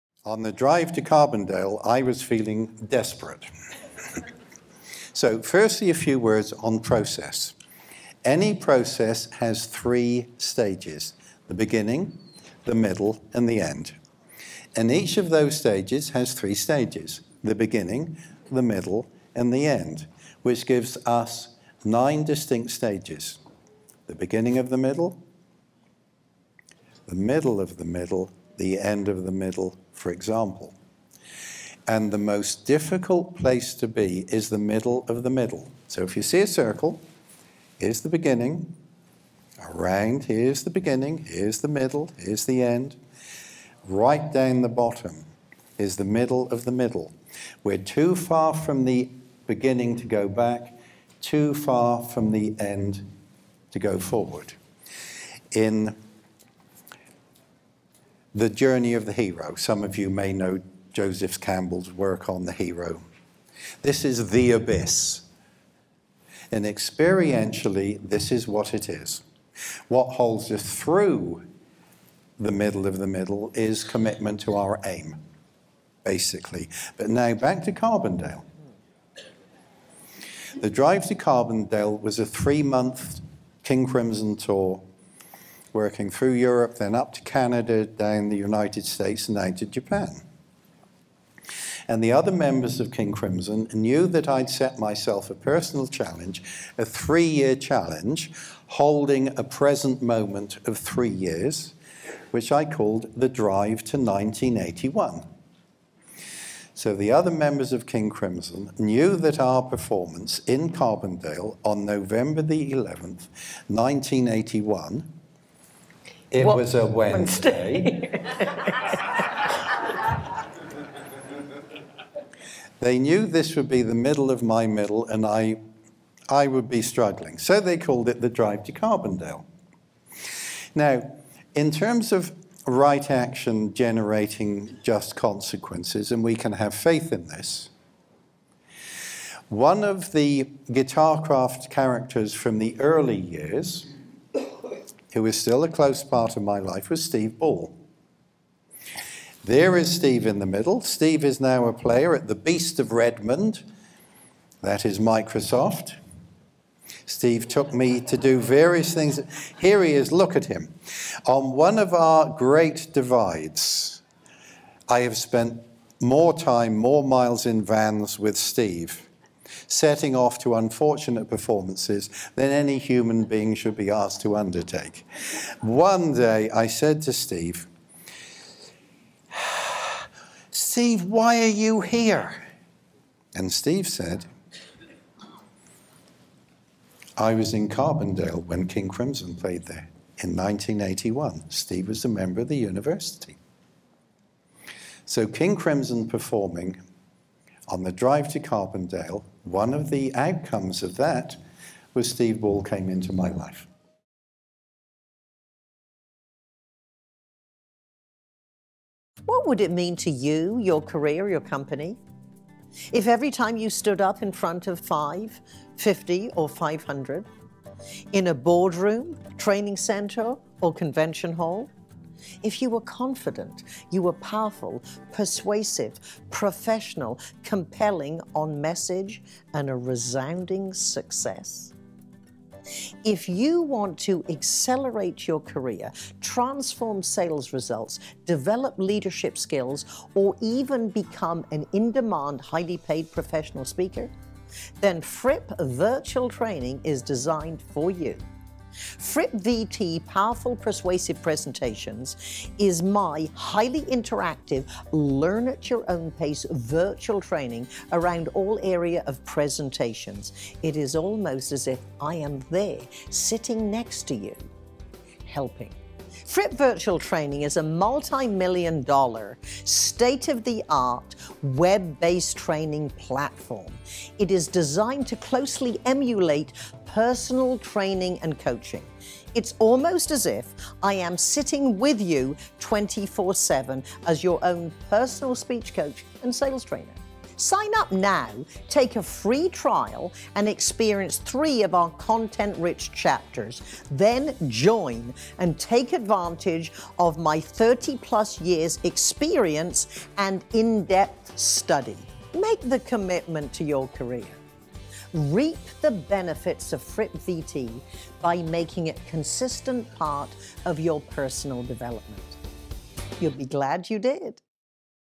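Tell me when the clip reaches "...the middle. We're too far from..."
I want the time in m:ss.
0:46.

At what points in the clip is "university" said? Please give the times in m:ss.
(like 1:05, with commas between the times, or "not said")
3:12.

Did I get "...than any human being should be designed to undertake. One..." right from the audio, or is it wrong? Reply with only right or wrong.
wrong.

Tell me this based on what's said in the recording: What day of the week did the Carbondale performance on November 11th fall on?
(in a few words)
Wednesday.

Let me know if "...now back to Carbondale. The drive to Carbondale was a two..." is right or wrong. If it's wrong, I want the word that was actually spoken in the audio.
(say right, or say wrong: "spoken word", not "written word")
wrong: "three", not "two".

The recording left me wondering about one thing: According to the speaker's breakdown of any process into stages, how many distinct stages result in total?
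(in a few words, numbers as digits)
9.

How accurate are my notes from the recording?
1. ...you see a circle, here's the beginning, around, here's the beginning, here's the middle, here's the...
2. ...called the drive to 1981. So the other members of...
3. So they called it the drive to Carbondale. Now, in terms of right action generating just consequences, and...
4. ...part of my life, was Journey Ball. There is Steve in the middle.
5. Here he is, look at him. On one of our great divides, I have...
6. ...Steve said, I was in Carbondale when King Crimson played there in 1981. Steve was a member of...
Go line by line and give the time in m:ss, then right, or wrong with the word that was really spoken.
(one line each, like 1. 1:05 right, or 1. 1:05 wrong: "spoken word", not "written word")
1. 0:36 right
2. 1:42 right
3. 2:07 right
4. 2:26 wrong: "Steve", not "Journey"
5. 2:39 right
6. 3:03 right.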